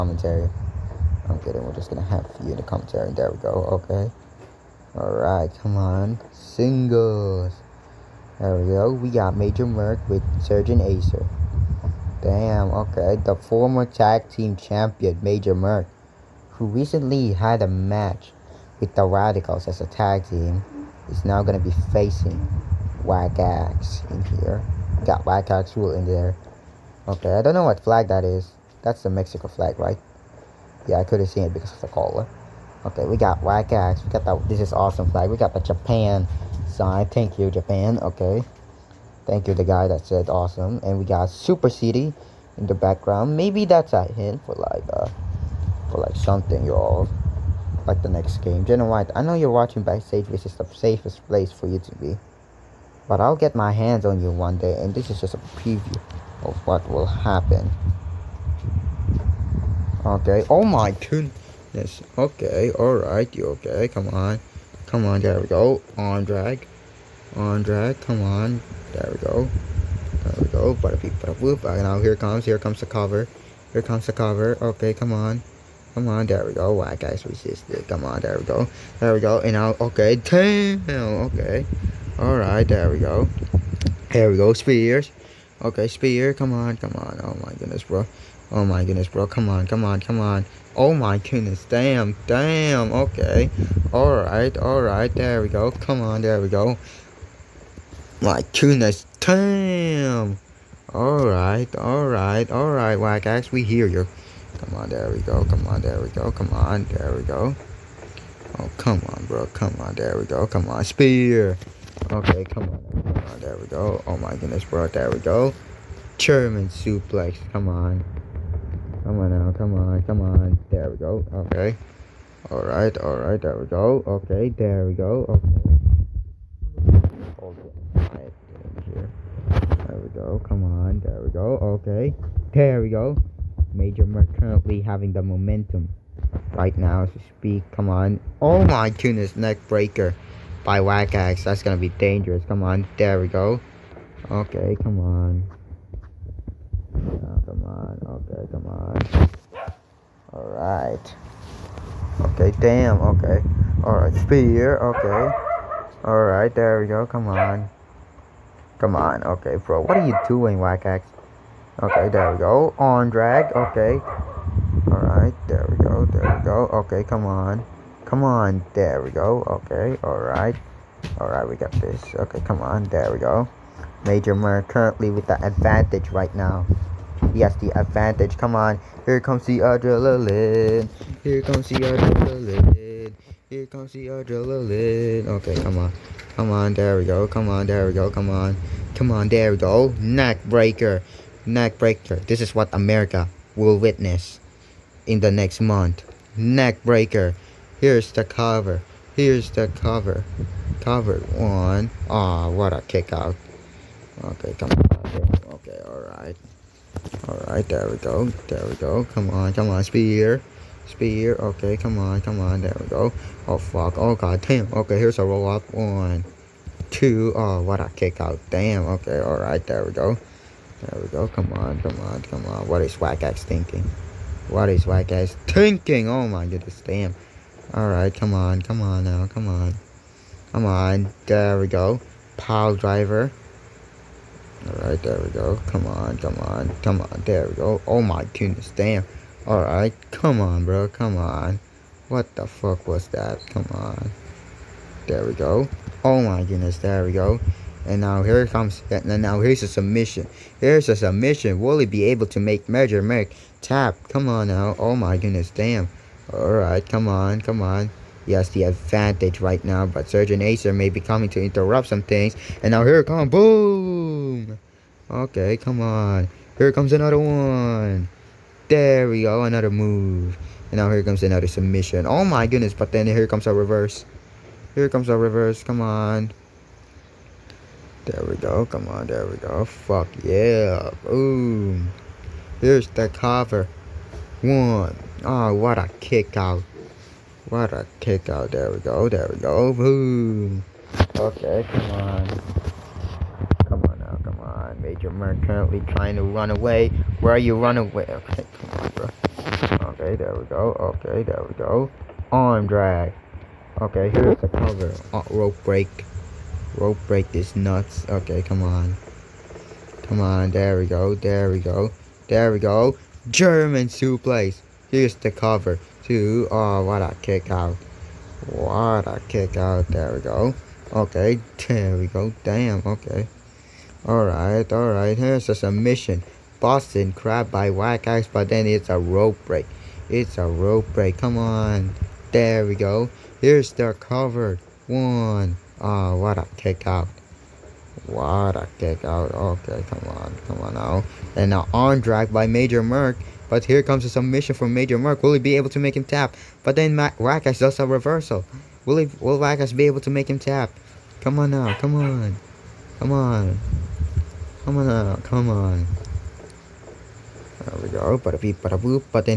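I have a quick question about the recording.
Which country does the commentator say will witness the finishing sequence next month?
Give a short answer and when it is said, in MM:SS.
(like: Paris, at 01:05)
America, at 03:12.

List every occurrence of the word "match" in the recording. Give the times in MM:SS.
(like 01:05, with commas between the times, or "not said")
00:17.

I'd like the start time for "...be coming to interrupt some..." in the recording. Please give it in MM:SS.
04:20.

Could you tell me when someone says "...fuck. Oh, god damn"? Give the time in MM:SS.
03:33.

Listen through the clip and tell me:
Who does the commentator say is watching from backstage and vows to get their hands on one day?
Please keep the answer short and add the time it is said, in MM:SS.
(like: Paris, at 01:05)
Jenna White, at 00:48.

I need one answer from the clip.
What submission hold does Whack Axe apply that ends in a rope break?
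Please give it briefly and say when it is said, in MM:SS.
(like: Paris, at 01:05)
Boston crab, at 05:26.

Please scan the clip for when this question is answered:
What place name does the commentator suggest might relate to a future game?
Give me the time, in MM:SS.
00:41.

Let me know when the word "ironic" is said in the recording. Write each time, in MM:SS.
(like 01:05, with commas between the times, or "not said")
not said.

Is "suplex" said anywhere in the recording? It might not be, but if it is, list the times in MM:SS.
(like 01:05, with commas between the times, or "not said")
01:56, 05:13.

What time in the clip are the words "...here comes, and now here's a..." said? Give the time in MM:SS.
04:08.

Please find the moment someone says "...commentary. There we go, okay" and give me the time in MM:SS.
00:02.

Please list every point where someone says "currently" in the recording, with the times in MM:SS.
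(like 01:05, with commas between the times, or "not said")
02:14, 02:54, 04:55.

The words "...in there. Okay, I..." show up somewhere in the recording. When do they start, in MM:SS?
00:25.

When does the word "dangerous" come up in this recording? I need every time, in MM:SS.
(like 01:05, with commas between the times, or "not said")
02:21.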